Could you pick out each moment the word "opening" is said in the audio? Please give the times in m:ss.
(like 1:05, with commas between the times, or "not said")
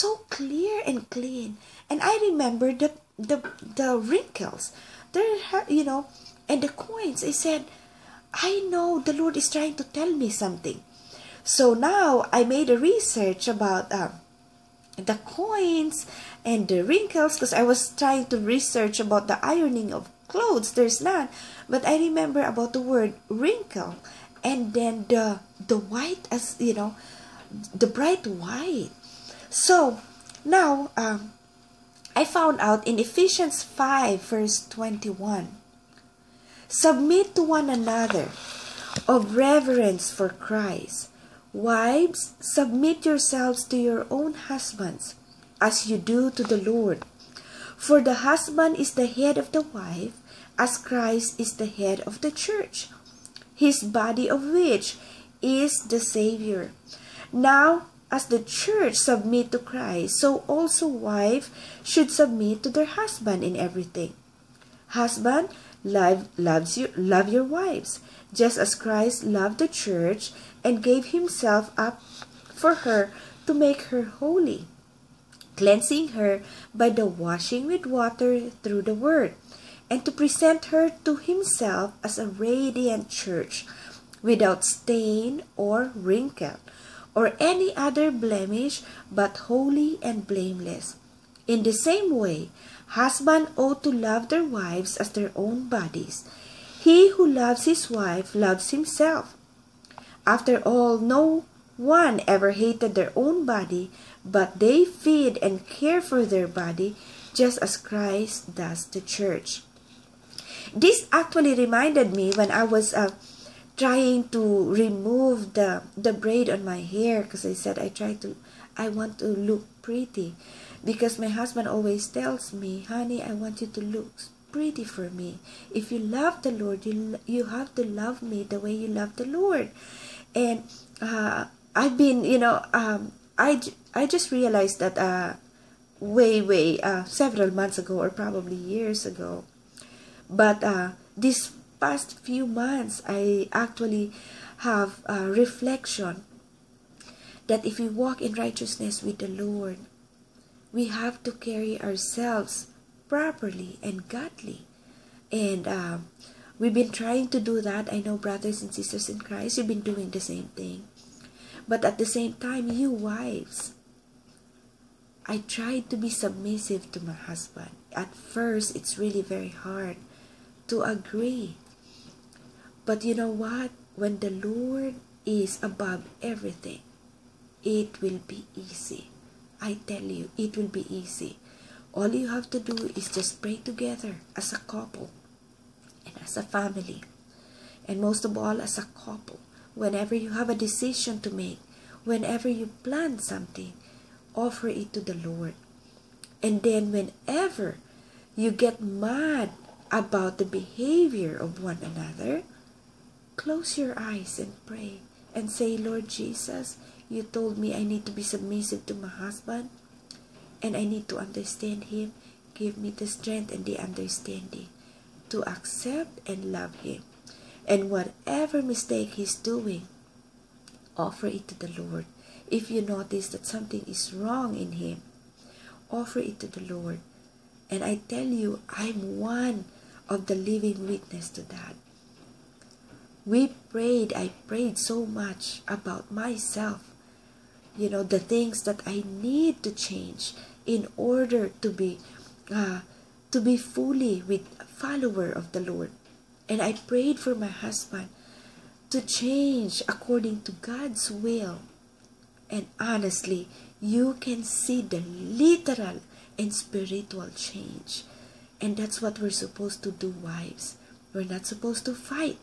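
not said.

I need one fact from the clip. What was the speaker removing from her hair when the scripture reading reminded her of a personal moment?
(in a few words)
braid.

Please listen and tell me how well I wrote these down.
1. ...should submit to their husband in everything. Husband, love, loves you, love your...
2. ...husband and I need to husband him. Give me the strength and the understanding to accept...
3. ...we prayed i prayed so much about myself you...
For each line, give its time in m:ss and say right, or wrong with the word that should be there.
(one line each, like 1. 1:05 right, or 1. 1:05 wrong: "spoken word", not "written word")
1. 1:01 right
2. 3:29 wrong: "understand", not "husband"
3. 3:53 right.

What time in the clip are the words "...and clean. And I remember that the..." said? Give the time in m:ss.
0:00.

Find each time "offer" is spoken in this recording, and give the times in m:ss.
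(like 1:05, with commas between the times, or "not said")
3:14, 3:40, 3:45.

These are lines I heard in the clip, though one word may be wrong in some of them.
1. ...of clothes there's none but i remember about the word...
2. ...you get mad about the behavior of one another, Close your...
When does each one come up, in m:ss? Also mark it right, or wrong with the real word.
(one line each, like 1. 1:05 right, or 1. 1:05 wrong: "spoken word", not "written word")
1. 0:19 right
2. 3:18 right.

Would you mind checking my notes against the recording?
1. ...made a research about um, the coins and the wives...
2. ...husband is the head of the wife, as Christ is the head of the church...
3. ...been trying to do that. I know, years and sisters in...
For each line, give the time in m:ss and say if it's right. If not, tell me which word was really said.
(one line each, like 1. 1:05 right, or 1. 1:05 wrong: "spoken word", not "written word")
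1. 0:12 wrong: "wrinkles", not "wives"
2. 0:48 right
3. 2:36 wrong: "brothers", not "years".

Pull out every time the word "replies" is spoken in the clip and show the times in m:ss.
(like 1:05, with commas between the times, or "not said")
not said.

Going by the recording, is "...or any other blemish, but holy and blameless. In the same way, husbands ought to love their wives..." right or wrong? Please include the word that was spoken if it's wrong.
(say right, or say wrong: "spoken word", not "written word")
right.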